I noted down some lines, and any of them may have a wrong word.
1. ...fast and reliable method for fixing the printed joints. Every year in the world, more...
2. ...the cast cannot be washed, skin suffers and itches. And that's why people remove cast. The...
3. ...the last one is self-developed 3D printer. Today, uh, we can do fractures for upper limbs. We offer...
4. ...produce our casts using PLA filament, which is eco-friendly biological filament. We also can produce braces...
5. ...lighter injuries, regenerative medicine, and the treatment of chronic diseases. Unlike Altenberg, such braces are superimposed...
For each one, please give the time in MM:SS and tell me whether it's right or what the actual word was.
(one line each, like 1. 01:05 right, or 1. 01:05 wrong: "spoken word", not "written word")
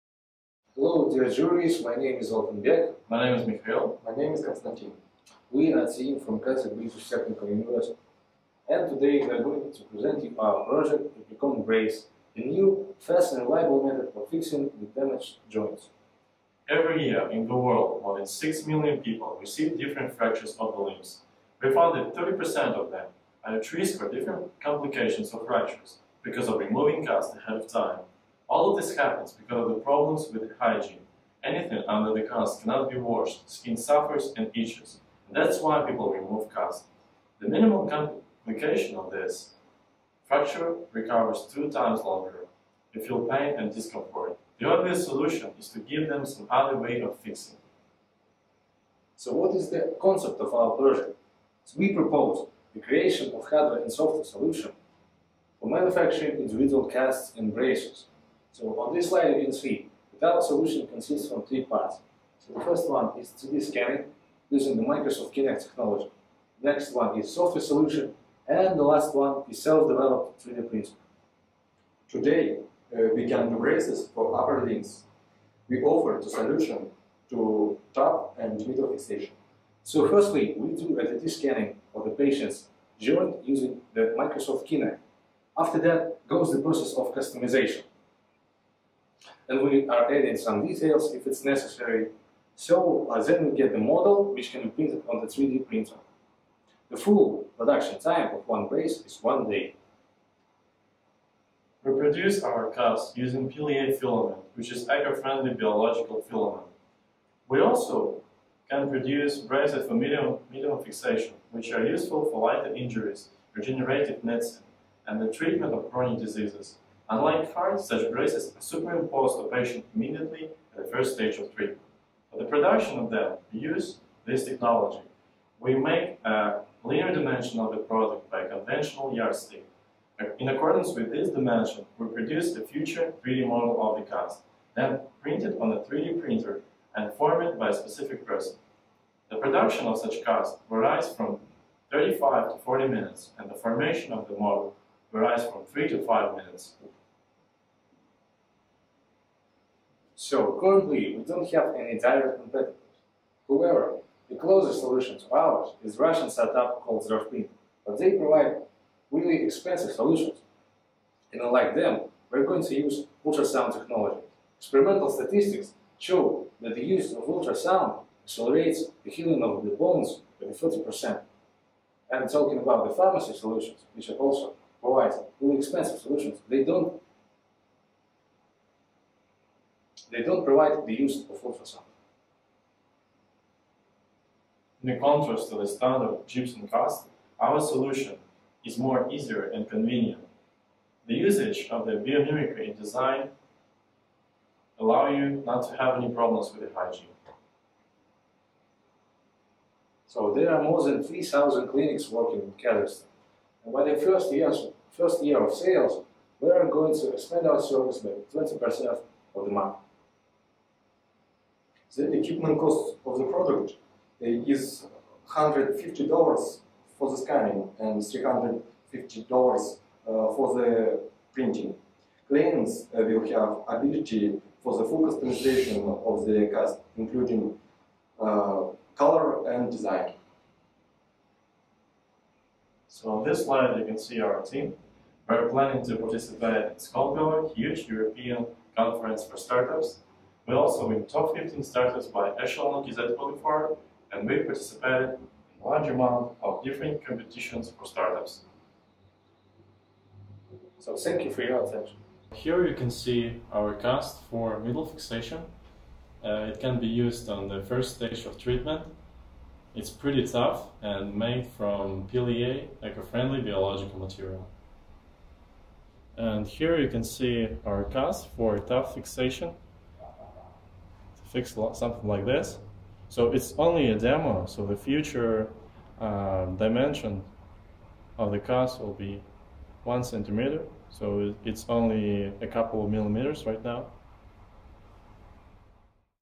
1. 00:13 wrong: "damaged", not "printed"
2. 00:32 right
3. 01:08 wrong: "braces", not "fractures"
4. 01:41 right
5. 01:52 wrong: "FIND", not "Altenberg".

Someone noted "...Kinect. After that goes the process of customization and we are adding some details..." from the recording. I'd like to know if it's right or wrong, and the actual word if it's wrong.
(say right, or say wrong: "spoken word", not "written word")
right.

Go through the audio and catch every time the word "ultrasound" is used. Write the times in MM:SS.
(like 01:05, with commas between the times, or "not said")
02:43, 02:47, 03:01.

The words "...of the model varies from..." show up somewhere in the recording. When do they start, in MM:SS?
02:24.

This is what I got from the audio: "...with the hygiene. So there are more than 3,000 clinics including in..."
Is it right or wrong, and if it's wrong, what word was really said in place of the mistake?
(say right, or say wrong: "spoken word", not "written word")
wrong: "working", not "including".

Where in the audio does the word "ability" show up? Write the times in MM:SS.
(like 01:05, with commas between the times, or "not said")
03:43.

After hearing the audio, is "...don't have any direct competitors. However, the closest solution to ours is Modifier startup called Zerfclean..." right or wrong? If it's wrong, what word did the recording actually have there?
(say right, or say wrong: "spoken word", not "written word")
wrong: "Russian", not "Modifier".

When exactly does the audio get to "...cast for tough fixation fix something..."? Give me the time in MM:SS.
04:27.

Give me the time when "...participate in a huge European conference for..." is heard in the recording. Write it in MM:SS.
03:55.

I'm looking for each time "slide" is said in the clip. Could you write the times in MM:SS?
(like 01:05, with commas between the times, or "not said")
00:59, 03:53.